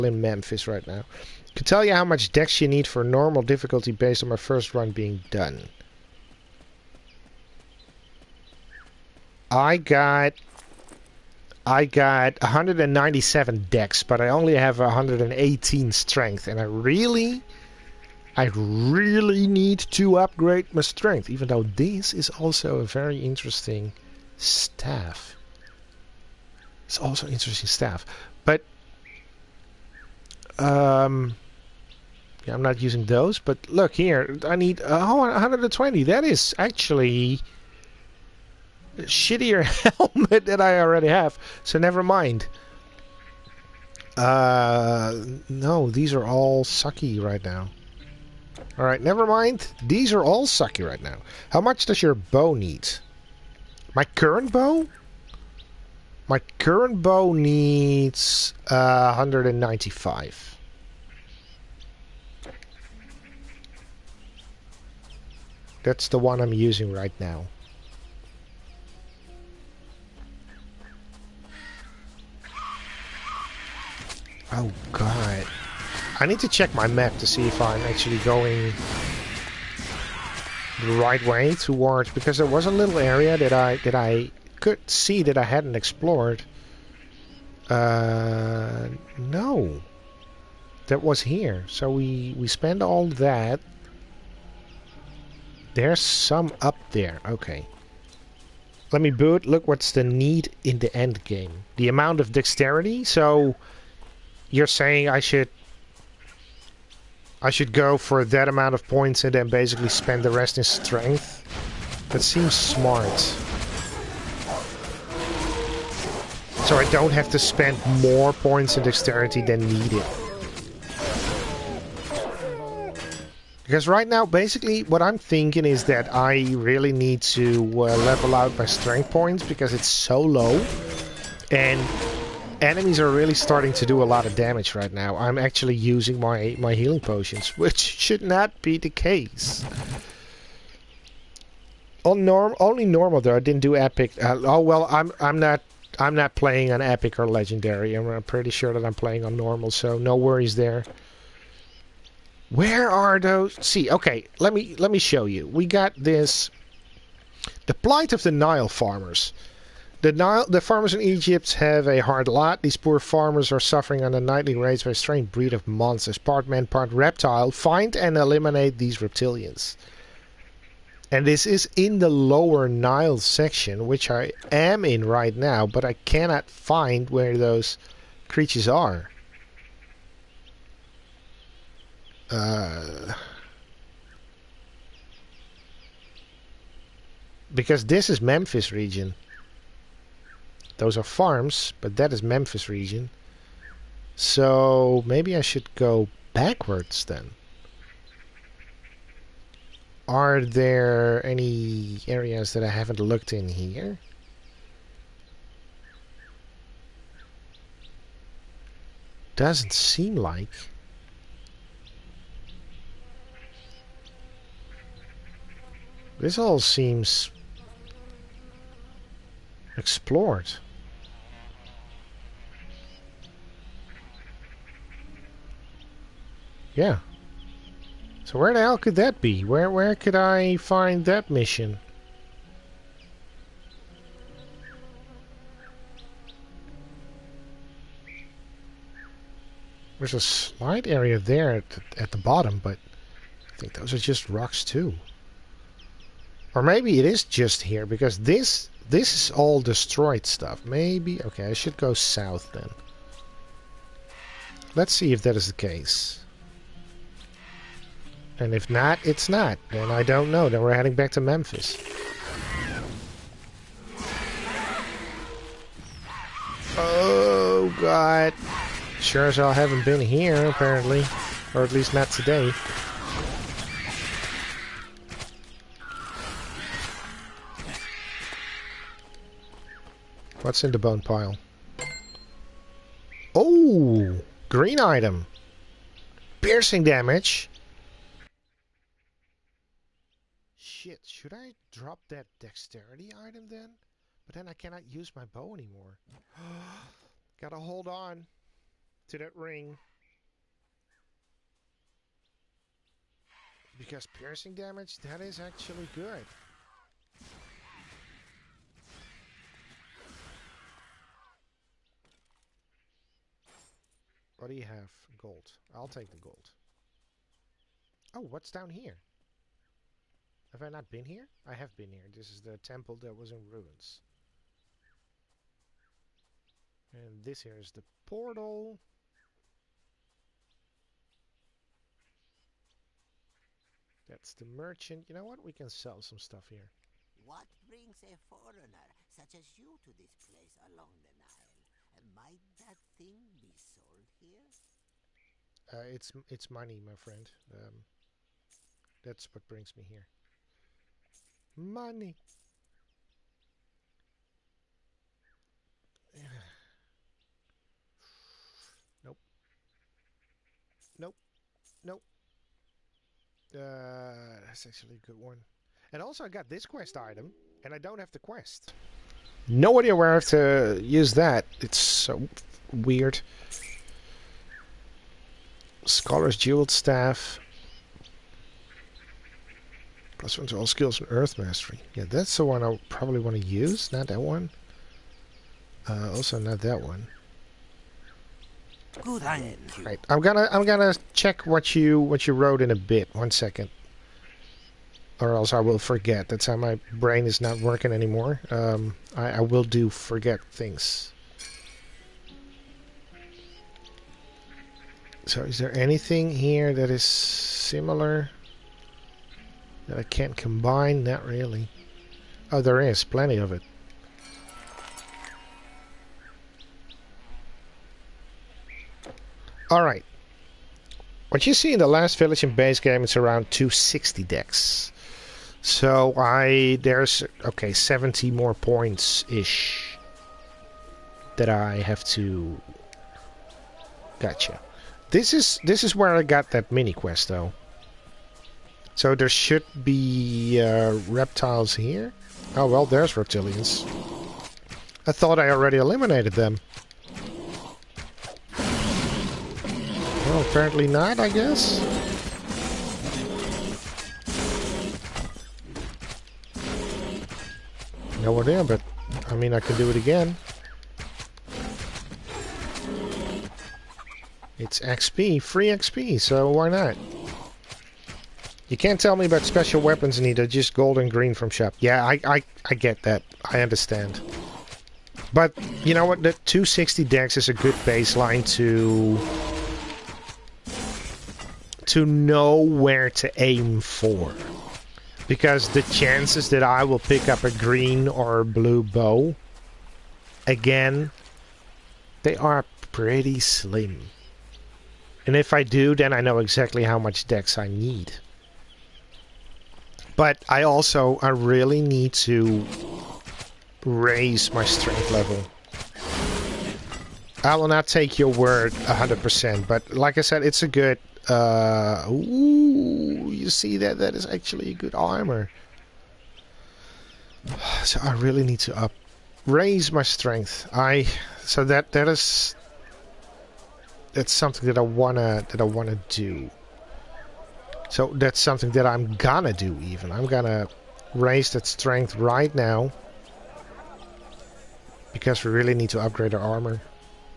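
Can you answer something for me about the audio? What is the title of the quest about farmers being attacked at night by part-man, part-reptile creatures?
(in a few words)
The Plight of the Nile Farmers.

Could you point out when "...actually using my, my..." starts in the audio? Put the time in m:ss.
2:15.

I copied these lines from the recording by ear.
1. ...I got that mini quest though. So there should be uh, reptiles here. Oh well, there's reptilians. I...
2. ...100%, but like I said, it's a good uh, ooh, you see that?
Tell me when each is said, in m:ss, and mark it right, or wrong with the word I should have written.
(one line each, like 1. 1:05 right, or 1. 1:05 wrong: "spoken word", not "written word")
1. 7:16 right
2. 8:28 right.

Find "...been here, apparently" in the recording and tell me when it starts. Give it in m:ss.
4:29.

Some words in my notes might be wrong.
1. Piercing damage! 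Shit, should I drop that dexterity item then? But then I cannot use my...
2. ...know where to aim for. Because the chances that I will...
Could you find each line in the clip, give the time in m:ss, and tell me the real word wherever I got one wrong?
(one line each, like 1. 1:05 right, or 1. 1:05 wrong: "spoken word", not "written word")
1. 4:46 right
2. 8:02 right.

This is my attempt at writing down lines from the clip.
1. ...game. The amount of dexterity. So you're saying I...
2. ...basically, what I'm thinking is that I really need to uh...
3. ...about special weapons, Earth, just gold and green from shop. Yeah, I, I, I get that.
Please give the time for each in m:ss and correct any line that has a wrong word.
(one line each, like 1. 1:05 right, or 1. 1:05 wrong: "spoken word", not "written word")
1. 1:41 right
2. 2:04 right
3. 7:49 wrong: "Nita", not "Earth".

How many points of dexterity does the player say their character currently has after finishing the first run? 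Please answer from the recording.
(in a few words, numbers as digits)
197.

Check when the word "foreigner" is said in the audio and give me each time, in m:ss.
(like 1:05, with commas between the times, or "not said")
5:38.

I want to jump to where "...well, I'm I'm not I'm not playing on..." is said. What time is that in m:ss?
2:24.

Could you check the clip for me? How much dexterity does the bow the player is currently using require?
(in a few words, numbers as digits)
195.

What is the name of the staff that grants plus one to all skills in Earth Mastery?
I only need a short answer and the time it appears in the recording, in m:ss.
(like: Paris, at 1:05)
Scholar's Jeweled Staff, at 6:15.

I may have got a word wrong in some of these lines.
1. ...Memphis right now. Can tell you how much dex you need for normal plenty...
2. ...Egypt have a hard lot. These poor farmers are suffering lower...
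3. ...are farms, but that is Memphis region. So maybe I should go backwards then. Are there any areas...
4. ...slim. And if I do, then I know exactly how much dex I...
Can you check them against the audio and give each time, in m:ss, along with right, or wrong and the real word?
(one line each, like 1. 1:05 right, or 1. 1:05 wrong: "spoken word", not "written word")
1. 0:00 wrong: "difficulty", not "plenty"
2. 2:41 wrong: "under", not "lower"
3. 3:10 right
4. 8:13 right.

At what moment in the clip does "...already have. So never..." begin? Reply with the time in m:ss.
0:40.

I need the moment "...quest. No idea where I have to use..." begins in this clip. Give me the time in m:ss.
6:08.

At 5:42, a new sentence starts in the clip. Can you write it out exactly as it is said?
Might that thing be sold here?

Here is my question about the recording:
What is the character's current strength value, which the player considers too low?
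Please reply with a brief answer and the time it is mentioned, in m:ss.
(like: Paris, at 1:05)
118, at 0:14.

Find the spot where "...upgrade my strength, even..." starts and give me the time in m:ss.
0:20.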